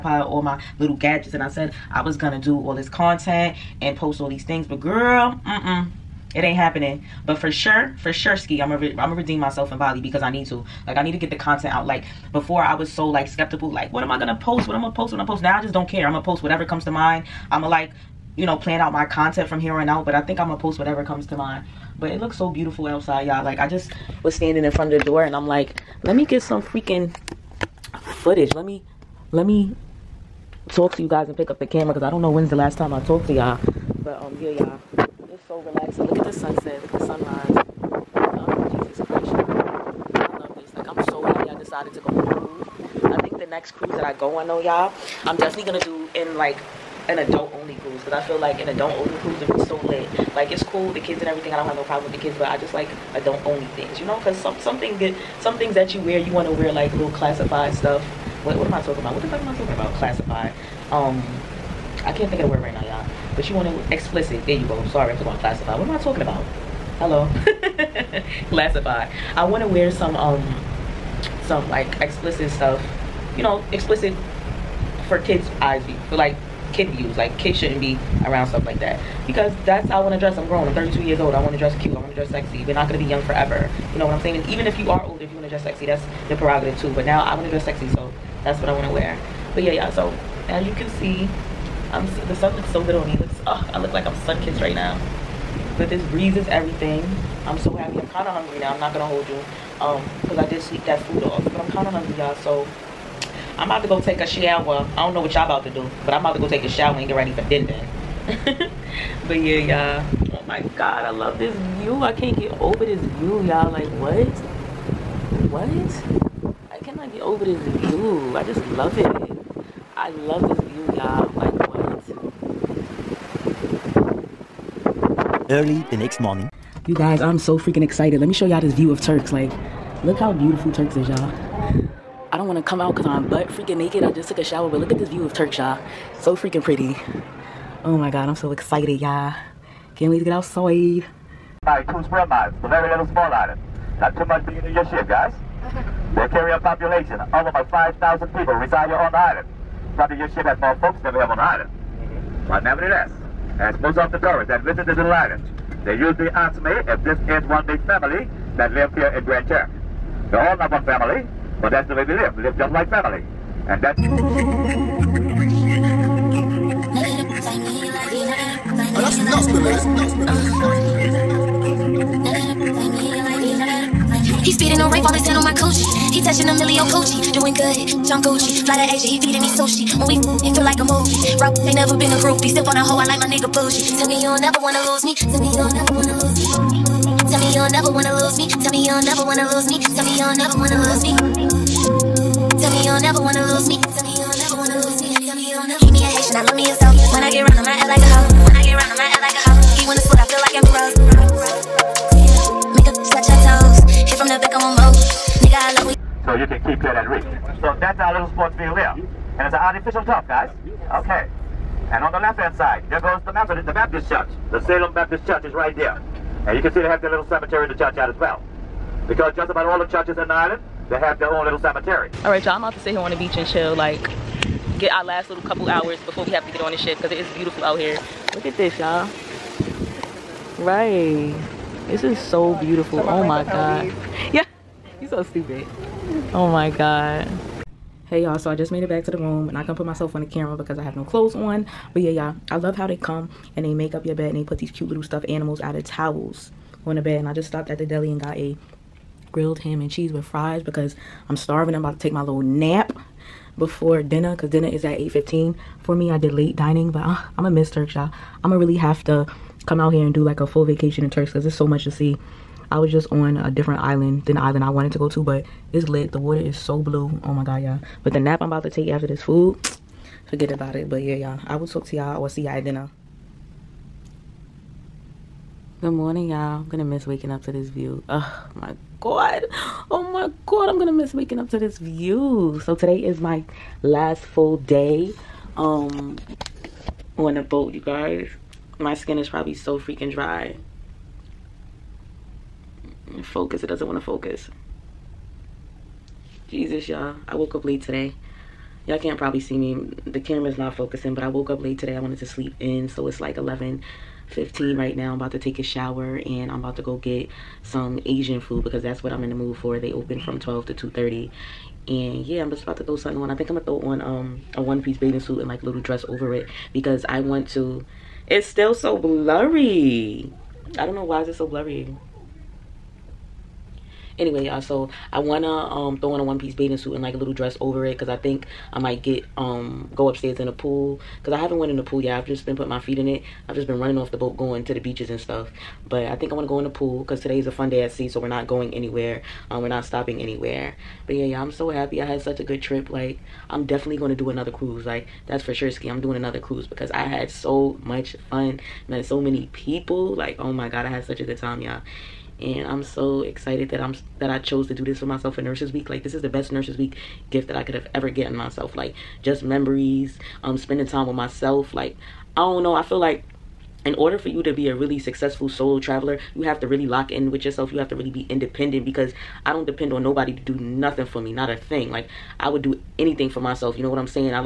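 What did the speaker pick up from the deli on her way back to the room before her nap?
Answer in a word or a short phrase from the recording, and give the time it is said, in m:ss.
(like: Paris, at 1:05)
Grilled ham and cheese, at 4:09.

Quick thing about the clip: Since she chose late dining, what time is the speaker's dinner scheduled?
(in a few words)
8:15.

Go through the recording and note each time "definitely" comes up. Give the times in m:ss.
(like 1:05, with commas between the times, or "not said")
0:45, 5:43.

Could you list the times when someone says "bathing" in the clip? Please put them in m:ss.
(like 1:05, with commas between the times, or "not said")
5:14, 5:26.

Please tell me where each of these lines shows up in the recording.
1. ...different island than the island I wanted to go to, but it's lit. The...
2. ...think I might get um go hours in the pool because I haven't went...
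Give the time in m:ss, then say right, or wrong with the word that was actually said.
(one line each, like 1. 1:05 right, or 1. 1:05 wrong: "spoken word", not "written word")
1. 4:23 right
2. 5:28 wrong: "upstairs", not "hours".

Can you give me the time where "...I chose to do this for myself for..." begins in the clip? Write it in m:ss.
5:54.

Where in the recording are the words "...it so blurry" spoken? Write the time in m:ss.
5:21.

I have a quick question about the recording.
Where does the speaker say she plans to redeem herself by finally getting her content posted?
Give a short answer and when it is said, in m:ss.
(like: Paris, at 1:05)
Bali, at 0:09.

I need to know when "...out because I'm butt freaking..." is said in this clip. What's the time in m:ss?
2:12.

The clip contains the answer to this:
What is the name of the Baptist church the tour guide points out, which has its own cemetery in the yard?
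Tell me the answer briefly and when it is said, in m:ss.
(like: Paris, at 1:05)
Salem Baptist Church, at 3:34.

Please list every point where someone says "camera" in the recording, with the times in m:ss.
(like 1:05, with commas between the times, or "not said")
0:31, 4:00, 5:00.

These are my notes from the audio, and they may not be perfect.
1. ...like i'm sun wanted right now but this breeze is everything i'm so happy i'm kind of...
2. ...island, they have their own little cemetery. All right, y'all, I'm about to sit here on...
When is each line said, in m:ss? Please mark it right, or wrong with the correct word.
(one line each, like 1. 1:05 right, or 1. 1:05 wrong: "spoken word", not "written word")
1. 1:33 wrong: "kissed", not "wanted"
2. 3:40 right.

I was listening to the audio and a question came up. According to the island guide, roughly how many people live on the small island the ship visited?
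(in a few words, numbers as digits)
5,000.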